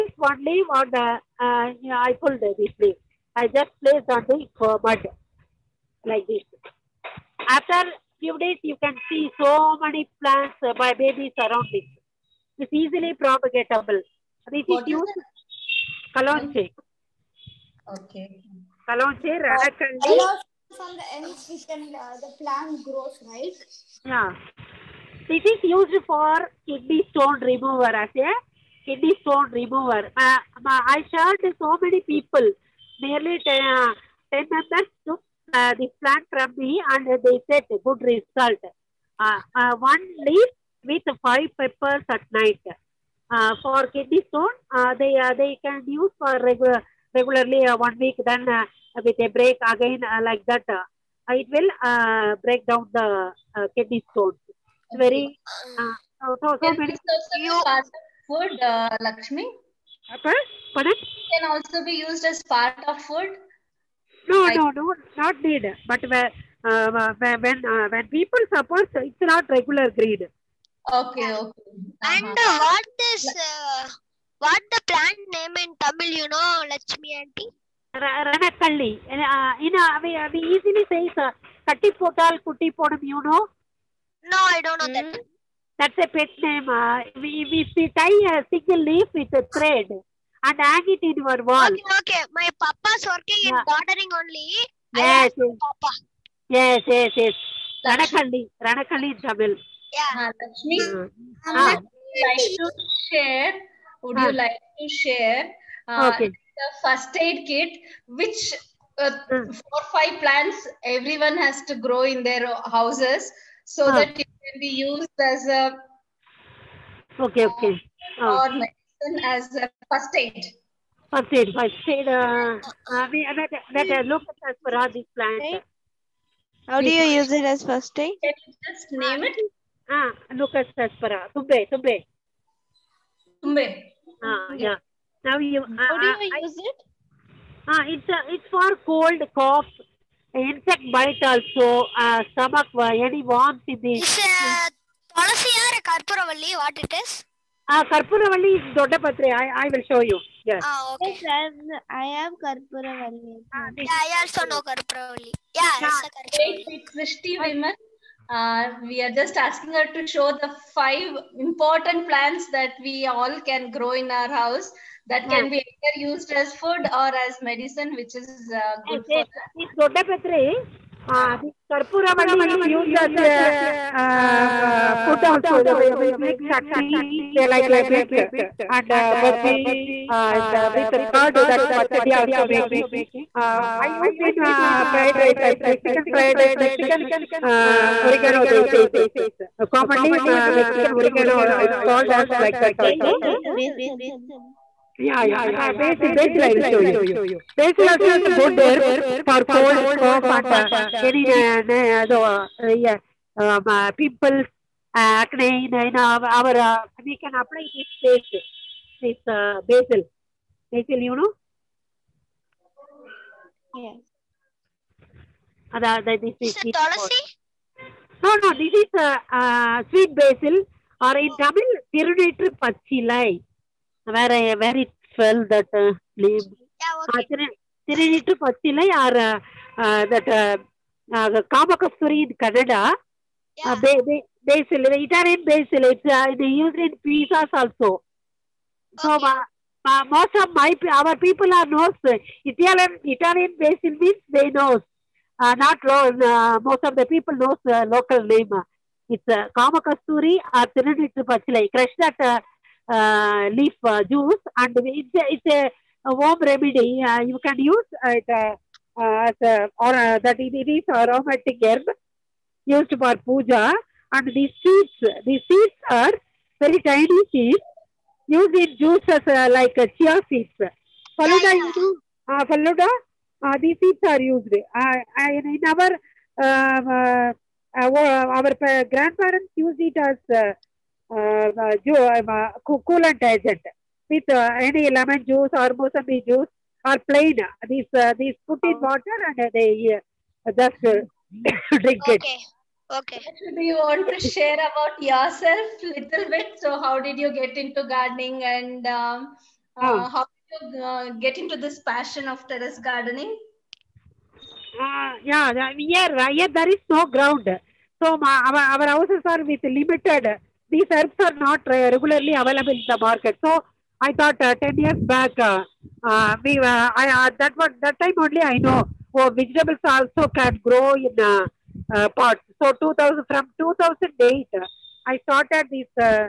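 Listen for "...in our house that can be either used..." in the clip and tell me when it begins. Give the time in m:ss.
2:43.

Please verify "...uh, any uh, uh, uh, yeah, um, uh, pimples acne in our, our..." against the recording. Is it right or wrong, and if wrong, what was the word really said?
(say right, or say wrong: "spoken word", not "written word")
right.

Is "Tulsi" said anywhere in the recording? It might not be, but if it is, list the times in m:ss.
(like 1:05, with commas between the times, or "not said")
3:36.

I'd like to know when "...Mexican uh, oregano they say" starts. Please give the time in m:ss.
3:06.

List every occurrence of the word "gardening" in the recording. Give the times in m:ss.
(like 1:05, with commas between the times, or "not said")
1:33, 4:57, 5:02.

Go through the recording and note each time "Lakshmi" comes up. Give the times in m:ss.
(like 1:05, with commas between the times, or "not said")
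0:58, 1:16, 1:40.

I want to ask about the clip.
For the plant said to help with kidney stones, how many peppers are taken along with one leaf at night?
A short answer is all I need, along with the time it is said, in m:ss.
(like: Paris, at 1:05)
5, at 0:41.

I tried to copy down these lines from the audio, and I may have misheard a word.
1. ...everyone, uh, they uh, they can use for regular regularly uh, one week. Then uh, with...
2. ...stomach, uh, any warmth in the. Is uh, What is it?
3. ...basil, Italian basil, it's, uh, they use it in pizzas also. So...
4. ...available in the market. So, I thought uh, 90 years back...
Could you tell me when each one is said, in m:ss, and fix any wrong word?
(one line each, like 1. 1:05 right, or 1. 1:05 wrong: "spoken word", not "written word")
1. 0:44 wrong: "stone", not "everyone"
2. 2:22 right
3. 3:54 right
4. 5:12 wrong: "10", not "90".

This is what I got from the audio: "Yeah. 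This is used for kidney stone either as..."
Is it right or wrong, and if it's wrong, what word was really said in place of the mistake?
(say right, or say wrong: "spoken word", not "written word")
wrong: "remover", not "either".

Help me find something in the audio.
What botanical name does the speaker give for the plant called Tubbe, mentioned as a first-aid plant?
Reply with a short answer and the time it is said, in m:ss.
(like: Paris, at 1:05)
Leucas Aspera, at 2:10.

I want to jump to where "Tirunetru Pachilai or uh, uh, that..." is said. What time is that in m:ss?
3:47.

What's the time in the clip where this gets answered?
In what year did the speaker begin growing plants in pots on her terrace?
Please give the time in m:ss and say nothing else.
5:23.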